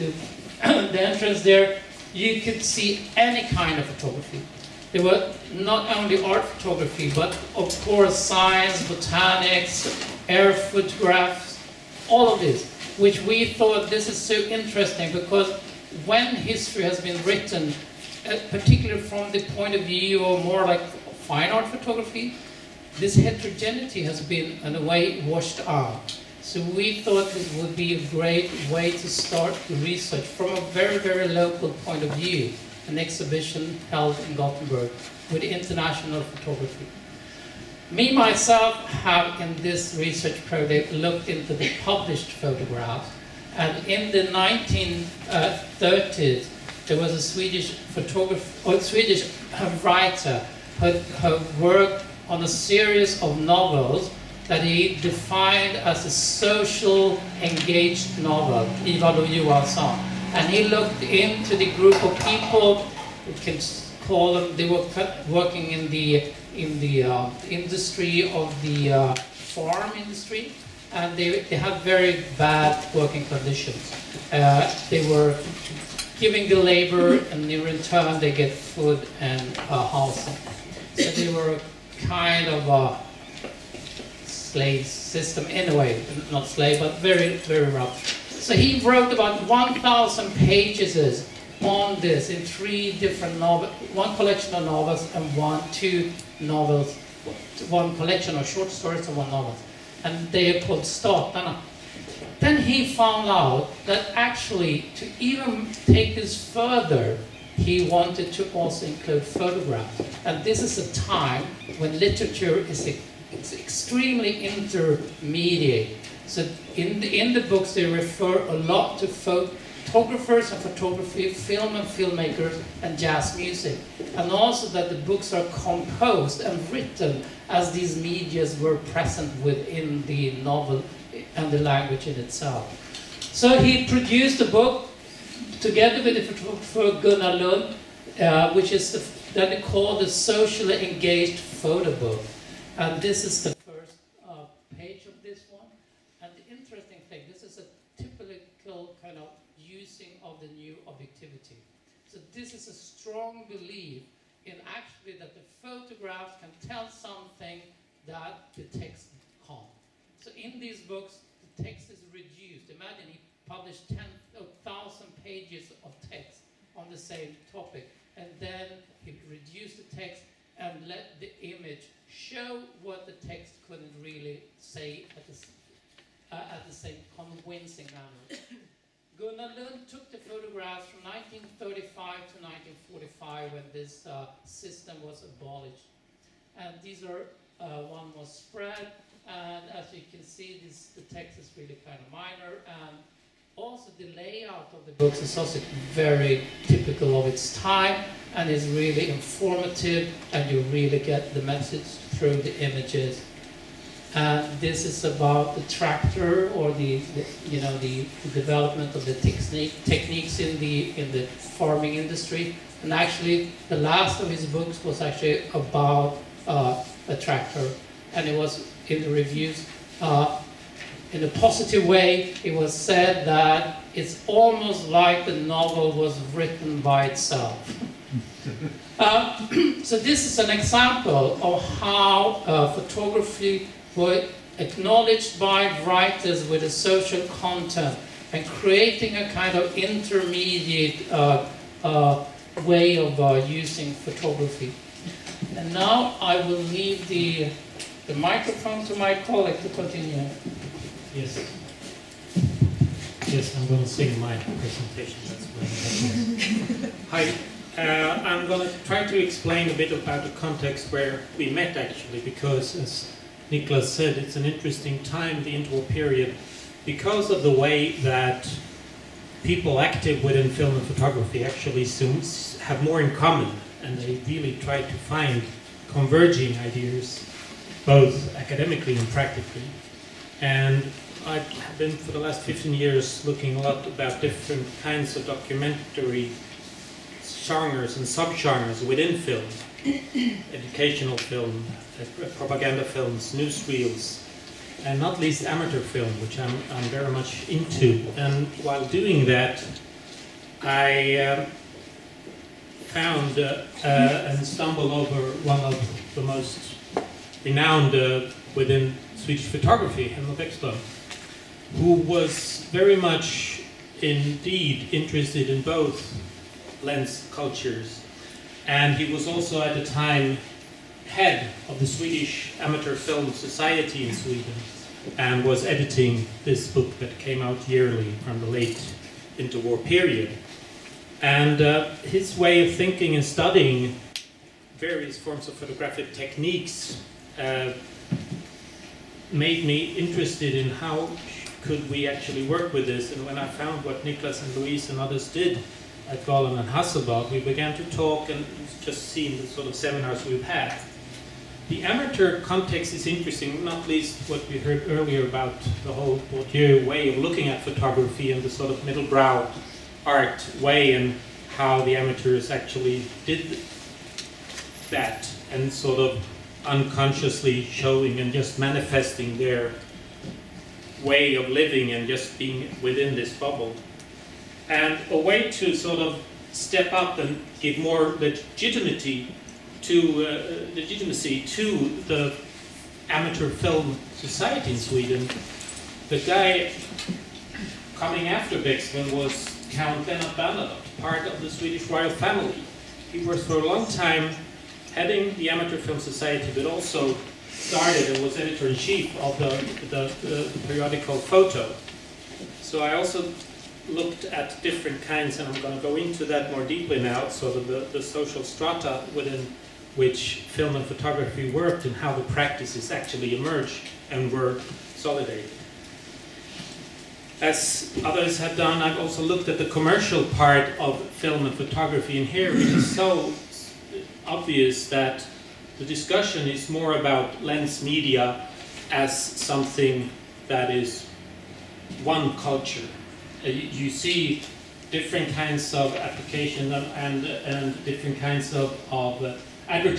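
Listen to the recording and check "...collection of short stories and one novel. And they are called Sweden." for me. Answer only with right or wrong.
wrong.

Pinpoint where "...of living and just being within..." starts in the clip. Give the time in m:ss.
6:11.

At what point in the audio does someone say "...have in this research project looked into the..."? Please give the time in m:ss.
0:38.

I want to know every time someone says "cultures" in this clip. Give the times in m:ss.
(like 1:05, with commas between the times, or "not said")
5:17, 7:12.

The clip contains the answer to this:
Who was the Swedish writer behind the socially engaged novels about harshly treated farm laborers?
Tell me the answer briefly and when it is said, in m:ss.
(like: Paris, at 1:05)
Ivar Johansson, at 0:58.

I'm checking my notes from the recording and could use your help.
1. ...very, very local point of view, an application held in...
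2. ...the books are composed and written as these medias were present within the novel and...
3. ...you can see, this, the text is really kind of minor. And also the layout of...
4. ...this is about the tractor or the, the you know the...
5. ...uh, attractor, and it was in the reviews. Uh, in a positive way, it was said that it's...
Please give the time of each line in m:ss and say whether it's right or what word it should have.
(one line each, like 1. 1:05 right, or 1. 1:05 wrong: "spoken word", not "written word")
1. 0:30 wrong: "exhibition", not "application"
2. 2:04 right
3. 3:09 right
4. 3:24 right
5. 3:36 right.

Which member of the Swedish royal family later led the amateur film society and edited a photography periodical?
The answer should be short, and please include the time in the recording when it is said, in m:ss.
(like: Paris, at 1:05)
Lennart Bernadotte, at 6:30.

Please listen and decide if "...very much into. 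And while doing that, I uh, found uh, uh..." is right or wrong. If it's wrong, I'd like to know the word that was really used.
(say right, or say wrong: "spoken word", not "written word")
right.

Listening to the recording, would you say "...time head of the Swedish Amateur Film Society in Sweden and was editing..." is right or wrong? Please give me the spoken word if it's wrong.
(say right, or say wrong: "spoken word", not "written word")
right.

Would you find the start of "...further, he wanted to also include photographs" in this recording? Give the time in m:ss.
1:46.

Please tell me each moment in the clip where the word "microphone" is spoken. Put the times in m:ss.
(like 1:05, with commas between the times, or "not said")
4:08.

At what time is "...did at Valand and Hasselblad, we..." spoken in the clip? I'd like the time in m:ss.
5:45.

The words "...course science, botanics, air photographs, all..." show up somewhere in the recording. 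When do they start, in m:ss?
0:07.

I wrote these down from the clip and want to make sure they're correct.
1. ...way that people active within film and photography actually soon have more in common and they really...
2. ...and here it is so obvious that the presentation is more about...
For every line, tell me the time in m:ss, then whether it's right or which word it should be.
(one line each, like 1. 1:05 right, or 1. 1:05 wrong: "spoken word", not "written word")
1. 4:27 right
2. 7:02 wrong: "discussion", not "presentation".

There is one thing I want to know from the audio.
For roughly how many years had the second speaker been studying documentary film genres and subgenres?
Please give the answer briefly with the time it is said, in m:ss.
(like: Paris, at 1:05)
15, at 4:42.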